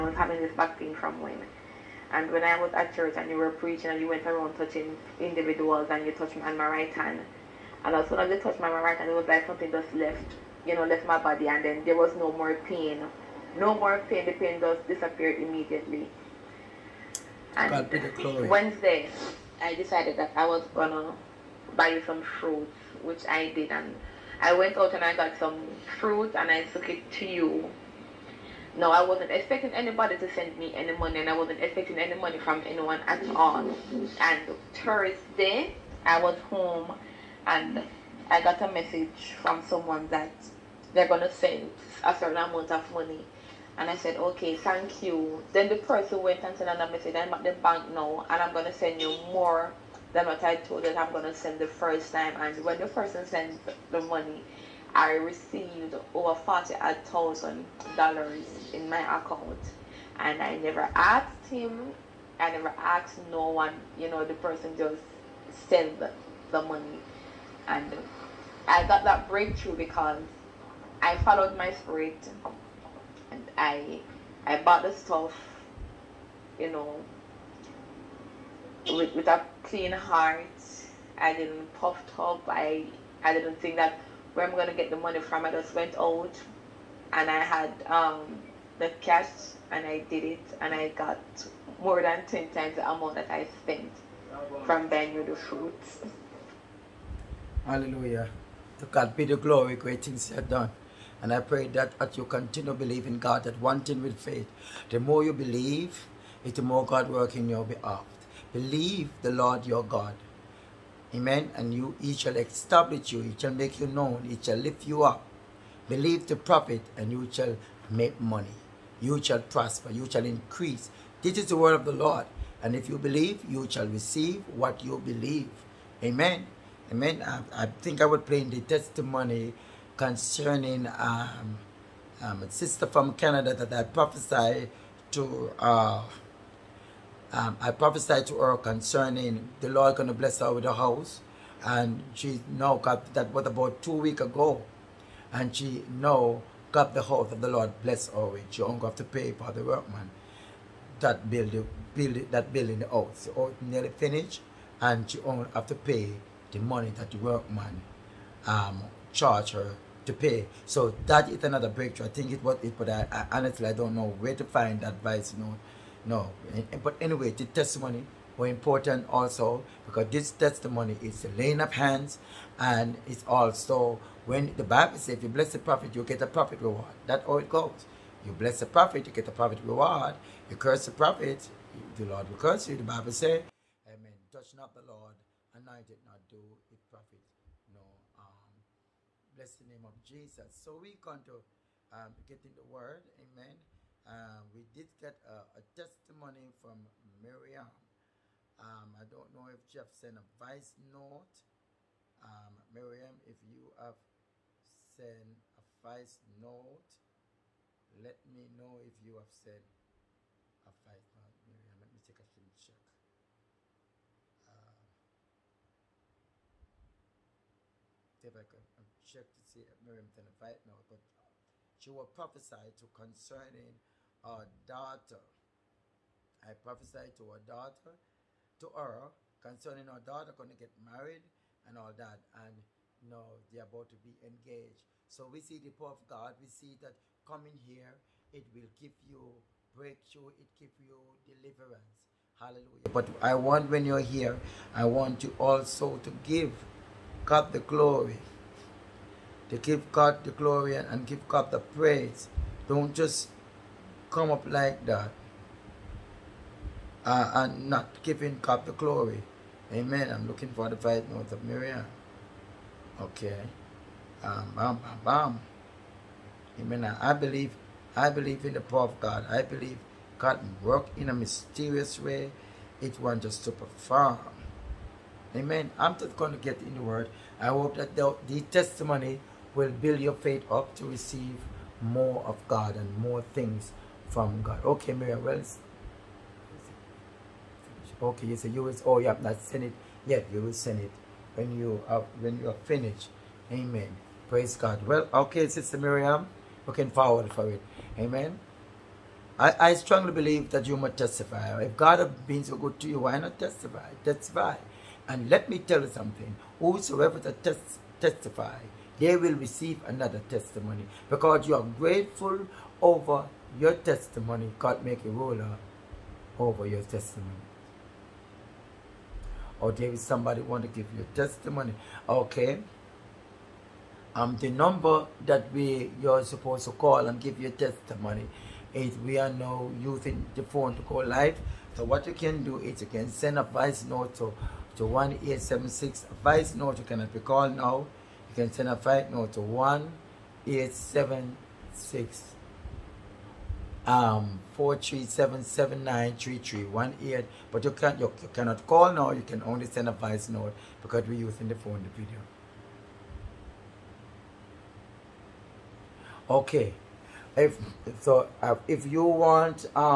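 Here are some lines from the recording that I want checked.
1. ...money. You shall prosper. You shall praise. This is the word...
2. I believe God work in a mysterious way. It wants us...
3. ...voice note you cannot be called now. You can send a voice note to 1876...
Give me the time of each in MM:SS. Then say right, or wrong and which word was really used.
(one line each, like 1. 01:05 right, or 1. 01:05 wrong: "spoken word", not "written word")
1. 01:58 wrong: "increase", not "praise"
2. 04:29 right
3. 05:36 right.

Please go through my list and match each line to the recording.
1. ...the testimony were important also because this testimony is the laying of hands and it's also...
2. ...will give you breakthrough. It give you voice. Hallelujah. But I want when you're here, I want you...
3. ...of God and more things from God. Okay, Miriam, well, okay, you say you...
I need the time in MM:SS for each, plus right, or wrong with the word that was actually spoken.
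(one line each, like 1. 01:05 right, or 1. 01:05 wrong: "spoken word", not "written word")
1. 02:47 right
2. 03:58 wrong: "deliverance", not "voice"
3. 04:42 right.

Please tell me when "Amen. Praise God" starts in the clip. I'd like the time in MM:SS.
04:53.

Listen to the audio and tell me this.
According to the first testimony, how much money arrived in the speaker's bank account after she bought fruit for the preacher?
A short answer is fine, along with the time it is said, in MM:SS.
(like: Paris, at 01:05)
over $40,000, at 00:56.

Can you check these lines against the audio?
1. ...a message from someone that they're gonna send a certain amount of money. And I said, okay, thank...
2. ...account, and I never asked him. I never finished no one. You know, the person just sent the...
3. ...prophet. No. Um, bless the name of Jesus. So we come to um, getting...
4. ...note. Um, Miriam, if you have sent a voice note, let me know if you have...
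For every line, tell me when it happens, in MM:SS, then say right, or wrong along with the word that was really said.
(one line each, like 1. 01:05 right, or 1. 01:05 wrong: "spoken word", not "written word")
1. 00:38 right
2. 00:59 wrong: "asked", not "finished"
3. 03:06 right
4. 03:20 right.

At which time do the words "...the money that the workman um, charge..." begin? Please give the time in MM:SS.
02:36.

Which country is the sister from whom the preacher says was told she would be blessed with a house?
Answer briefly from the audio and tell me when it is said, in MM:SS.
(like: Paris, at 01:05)
Canada, at 02:13.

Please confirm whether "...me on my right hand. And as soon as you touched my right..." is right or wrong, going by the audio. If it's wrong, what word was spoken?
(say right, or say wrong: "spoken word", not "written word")
right.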